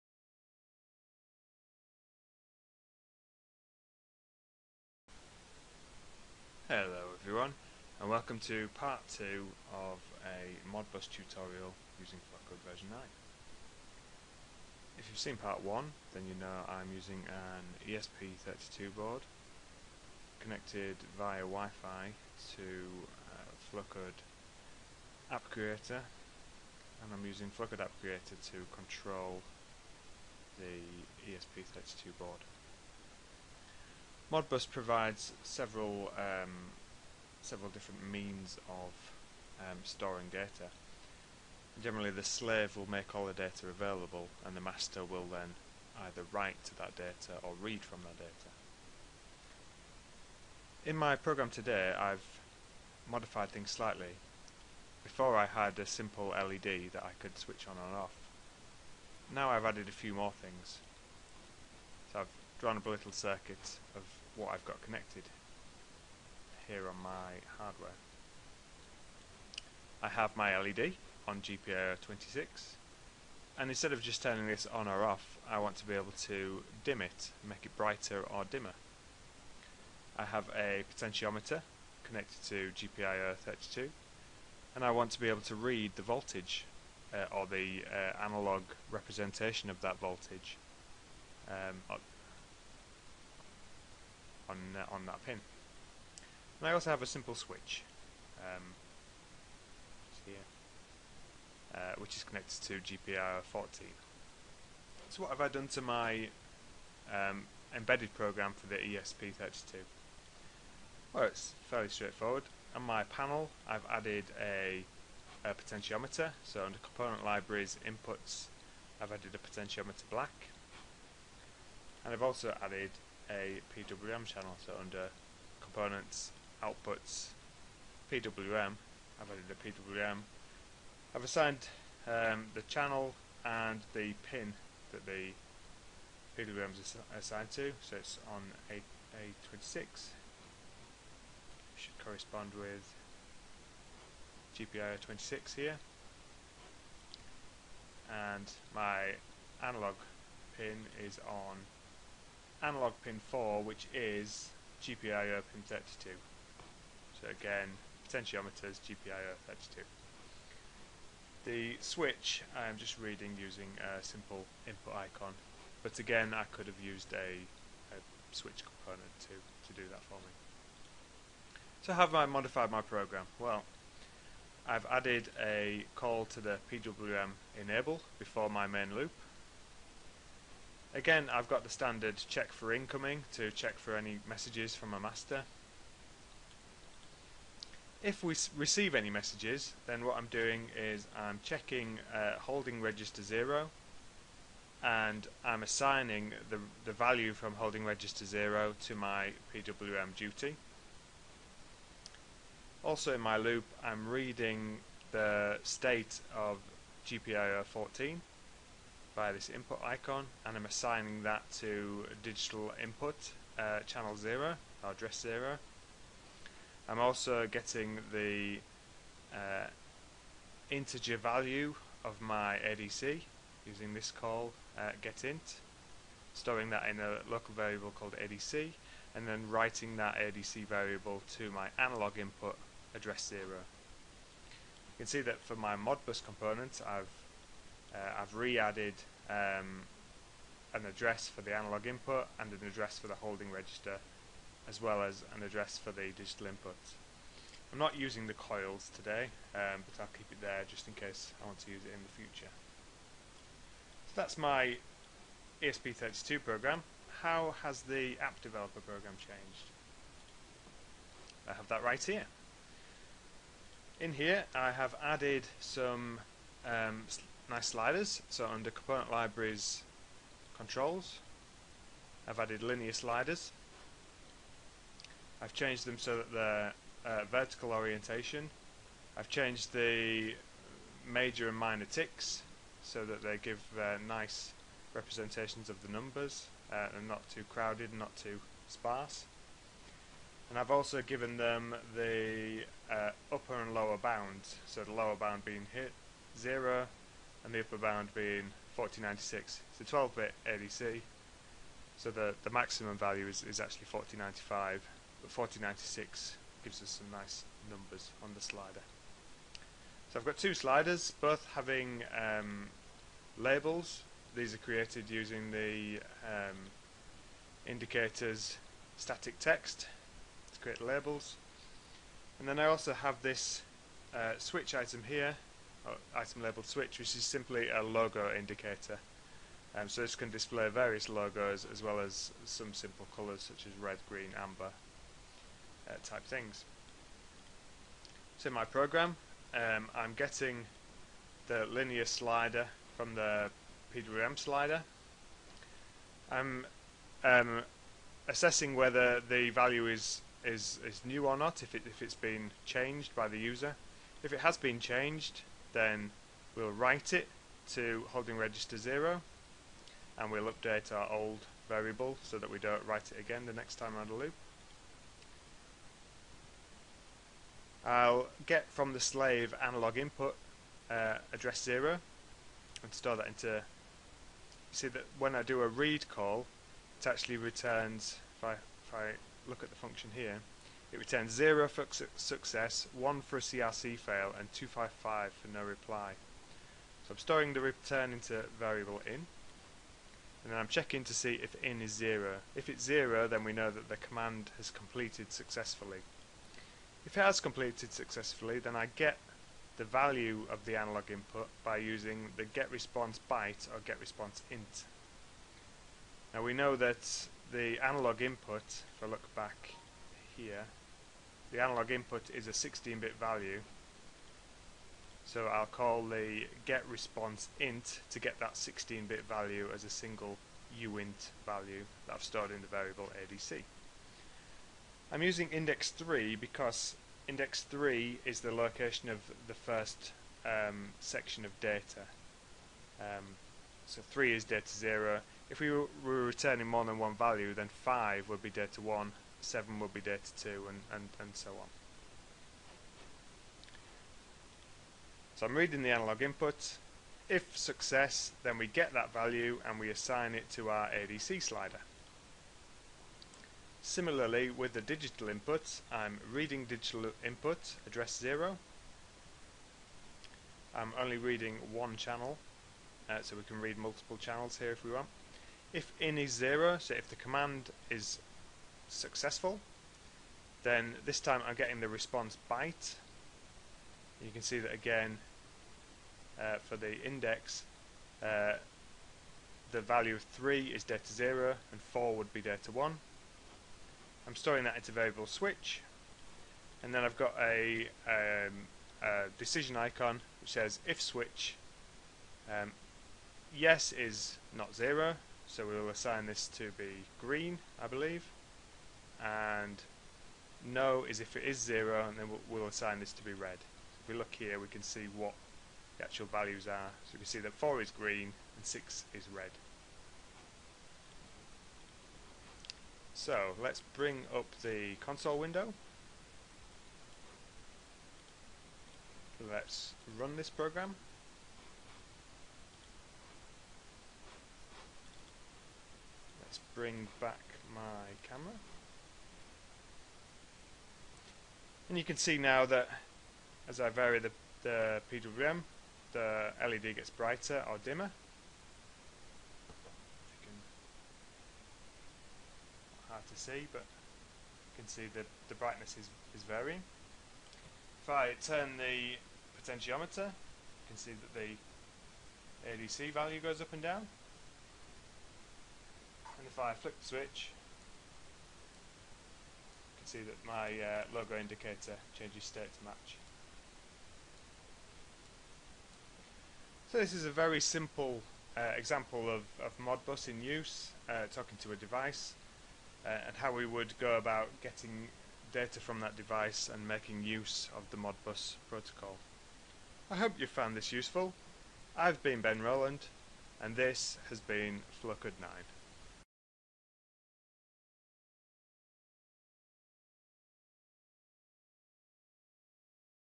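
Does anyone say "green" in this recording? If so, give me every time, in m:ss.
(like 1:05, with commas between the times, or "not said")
5:34, 8:17, 8:27.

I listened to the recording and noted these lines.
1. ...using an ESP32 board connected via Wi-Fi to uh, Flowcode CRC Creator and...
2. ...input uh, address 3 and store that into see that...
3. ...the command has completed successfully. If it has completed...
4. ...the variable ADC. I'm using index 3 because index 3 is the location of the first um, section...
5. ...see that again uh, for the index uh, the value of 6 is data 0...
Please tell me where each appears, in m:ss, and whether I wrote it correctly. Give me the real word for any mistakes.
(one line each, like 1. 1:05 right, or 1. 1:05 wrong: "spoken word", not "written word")
1. 0:16 wrong: "App", not "CRC"
2. 6:09 wrong: "0", not "3"
3. 6:33 right
4. 7:02 right
5. 7:54 wrong: "3", not "6".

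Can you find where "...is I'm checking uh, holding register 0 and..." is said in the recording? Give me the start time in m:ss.
3:10.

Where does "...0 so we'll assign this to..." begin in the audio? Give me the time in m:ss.
8:14.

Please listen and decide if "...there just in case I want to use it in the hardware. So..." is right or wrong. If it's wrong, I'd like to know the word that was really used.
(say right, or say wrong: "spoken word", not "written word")
wrong: "future", not "hardware".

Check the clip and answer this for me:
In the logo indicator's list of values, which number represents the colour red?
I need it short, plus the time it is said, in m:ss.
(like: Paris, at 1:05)
6, at 8:28.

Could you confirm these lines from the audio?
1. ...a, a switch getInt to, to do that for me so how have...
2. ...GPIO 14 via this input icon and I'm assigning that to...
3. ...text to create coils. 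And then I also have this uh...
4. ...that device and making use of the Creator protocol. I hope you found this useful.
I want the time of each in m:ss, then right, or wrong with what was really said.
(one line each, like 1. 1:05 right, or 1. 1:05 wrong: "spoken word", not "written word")
1. 2:47 wrong: "component", not "getInt"
2. 3:27 right
3. 5:19 wrong: "labels", not "coils"
4. 9:36 wrong: "Modbus", not "Creator".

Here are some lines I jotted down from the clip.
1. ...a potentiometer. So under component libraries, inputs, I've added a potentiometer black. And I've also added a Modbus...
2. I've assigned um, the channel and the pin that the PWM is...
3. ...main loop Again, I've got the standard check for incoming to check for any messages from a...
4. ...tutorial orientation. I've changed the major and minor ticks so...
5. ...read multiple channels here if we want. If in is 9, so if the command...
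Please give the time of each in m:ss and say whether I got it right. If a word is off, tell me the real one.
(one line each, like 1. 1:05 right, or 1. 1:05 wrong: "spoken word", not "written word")
1. 1:55 wrong: "PWM", not "Modbus"
2. 2:11 right
3. 2:58 right
4. 4:37 wrong: "vertical", not "tutorial"
5. 7:43 wrong: "0", not "9".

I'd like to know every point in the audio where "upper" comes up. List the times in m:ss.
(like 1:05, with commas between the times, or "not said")
4:53, 4:57.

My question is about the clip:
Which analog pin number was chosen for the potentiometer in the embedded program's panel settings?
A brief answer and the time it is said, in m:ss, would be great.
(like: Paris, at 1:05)
4, at 2:32.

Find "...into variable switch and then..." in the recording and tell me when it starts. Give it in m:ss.
8:04.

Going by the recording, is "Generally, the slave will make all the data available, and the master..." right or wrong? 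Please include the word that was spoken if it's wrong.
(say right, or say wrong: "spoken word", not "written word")
right.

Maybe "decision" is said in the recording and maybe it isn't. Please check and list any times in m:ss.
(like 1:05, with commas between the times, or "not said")
8:09.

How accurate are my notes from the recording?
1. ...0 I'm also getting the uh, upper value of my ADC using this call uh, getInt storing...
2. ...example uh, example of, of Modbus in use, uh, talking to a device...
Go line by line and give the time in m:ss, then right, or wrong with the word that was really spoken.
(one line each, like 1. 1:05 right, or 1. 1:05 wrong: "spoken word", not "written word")
1. 3:35 wrong: "integer", not "upper"
2. 9:27 wrong: "simple", not "example".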